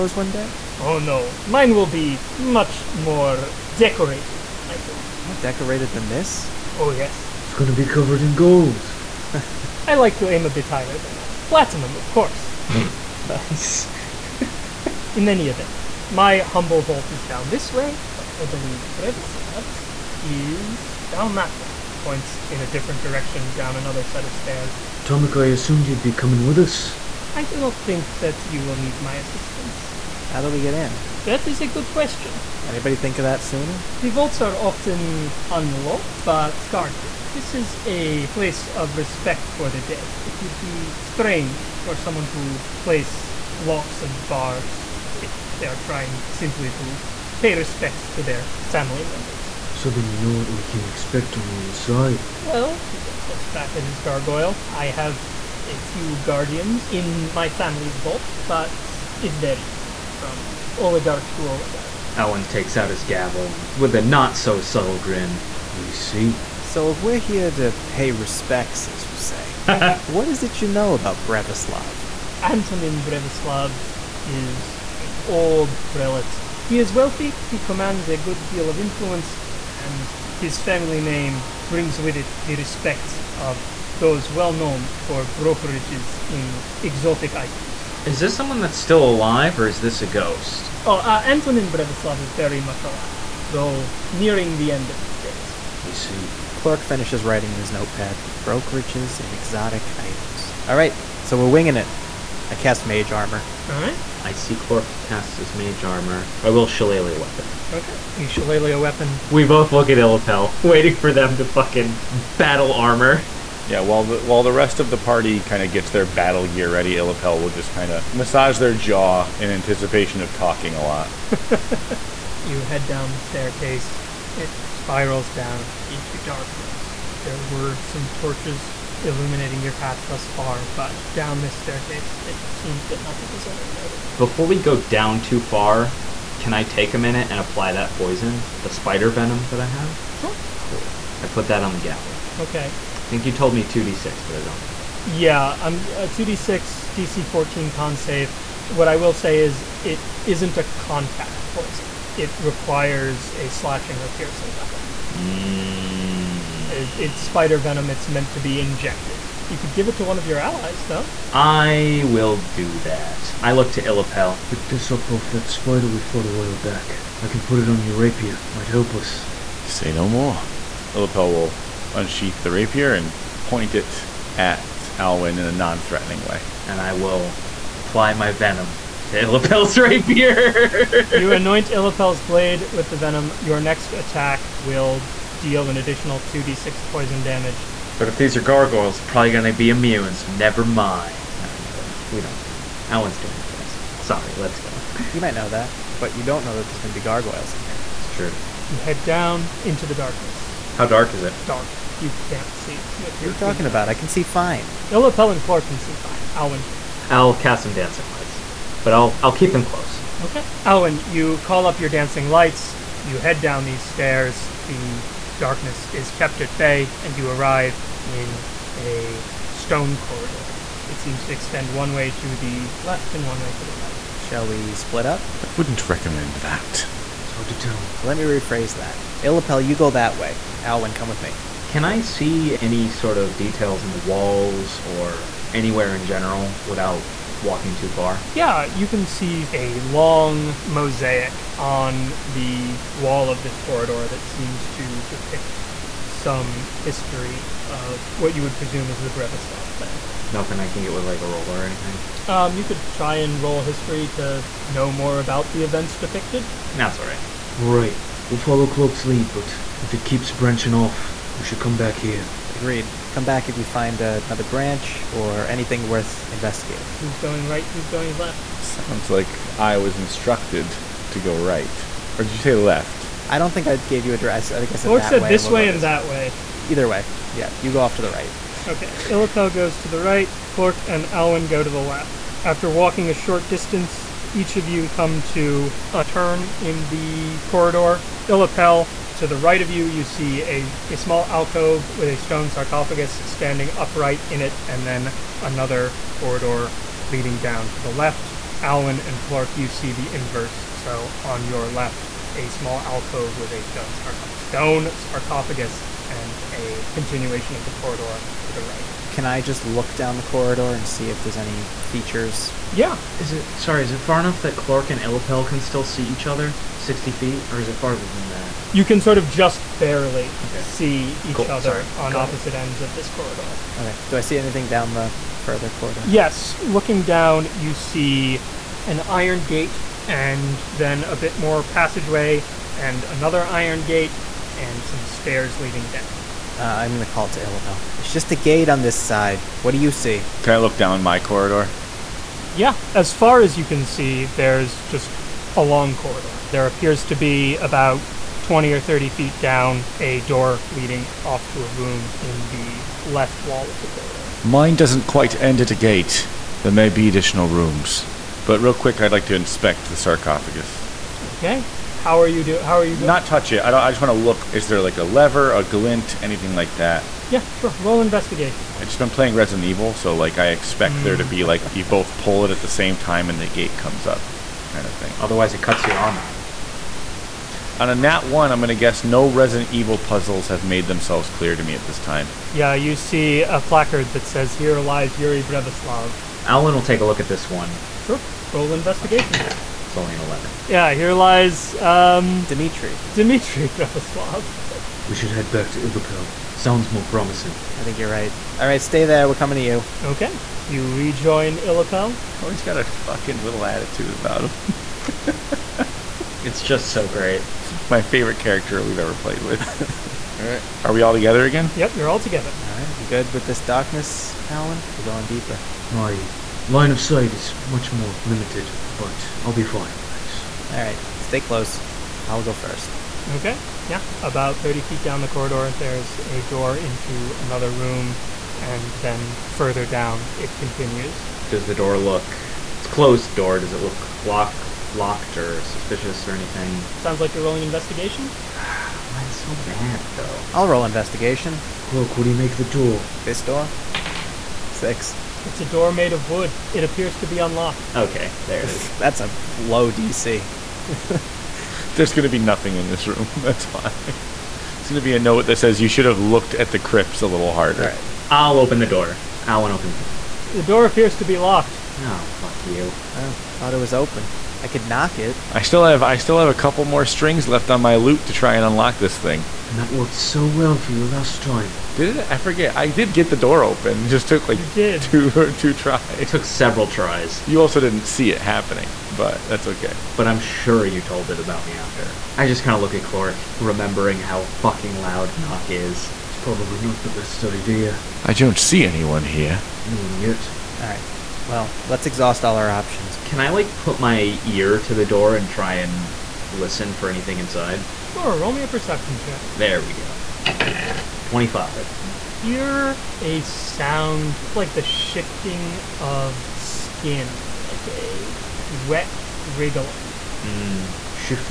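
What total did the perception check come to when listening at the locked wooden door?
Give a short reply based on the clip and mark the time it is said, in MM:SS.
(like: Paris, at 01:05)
25, at 08:21.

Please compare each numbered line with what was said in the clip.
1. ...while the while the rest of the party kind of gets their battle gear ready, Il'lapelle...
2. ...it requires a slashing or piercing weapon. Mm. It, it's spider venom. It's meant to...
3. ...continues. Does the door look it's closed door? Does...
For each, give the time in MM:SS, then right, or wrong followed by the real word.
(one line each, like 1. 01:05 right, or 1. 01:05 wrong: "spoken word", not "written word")
1. 01:53 right
2. 02:32 right
3. 07:10 right.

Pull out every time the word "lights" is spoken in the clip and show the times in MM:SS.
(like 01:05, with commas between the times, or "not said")
03:28, 03:32.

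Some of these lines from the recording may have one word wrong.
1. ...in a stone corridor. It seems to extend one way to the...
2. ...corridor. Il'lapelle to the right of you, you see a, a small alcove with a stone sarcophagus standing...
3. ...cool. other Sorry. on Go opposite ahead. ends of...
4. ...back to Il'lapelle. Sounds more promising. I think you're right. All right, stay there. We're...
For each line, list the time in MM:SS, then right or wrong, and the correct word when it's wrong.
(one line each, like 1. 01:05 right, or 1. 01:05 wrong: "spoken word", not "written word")
1. 03:38 right
2. 04:47 right
3. 05:21 right
4. 06:35 right.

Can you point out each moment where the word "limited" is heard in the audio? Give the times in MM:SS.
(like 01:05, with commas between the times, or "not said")
06:58.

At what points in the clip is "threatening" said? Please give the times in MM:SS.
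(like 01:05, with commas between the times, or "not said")
02:55.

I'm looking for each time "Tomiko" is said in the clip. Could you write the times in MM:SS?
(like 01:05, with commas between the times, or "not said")
00:25.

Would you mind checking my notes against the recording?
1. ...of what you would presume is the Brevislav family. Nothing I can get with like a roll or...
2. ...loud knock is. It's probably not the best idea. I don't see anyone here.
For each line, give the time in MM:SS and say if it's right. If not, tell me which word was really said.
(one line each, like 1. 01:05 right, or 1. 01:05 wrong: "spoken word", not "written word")
1. 04:07 right
2. 08:04 right.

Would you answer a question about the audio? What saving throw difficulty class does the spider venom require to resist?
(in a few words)
DC 14.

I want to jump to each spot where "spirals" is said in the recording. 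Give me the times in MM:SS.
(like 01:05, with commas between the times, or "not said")
02:04.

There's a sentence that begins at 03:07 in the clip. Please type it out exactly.
But if these are gargoyles, they're probably going to be immune, so never mind.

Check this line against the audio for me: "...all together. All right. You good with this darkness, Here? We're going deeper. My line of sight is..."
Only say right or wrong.
wrong.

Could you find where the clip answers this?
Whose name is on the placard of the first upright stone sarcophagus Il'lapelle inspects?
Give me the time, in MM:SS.
06:25.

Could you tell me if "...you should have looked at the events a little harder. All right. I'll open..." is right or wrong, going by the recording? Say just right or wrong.
wrong.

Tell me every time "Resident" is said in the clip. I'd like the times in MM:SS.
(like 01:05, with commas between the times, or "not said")
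06:09, 06:19.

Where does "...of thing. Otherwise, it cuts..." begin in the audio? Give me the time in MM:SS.
06:14.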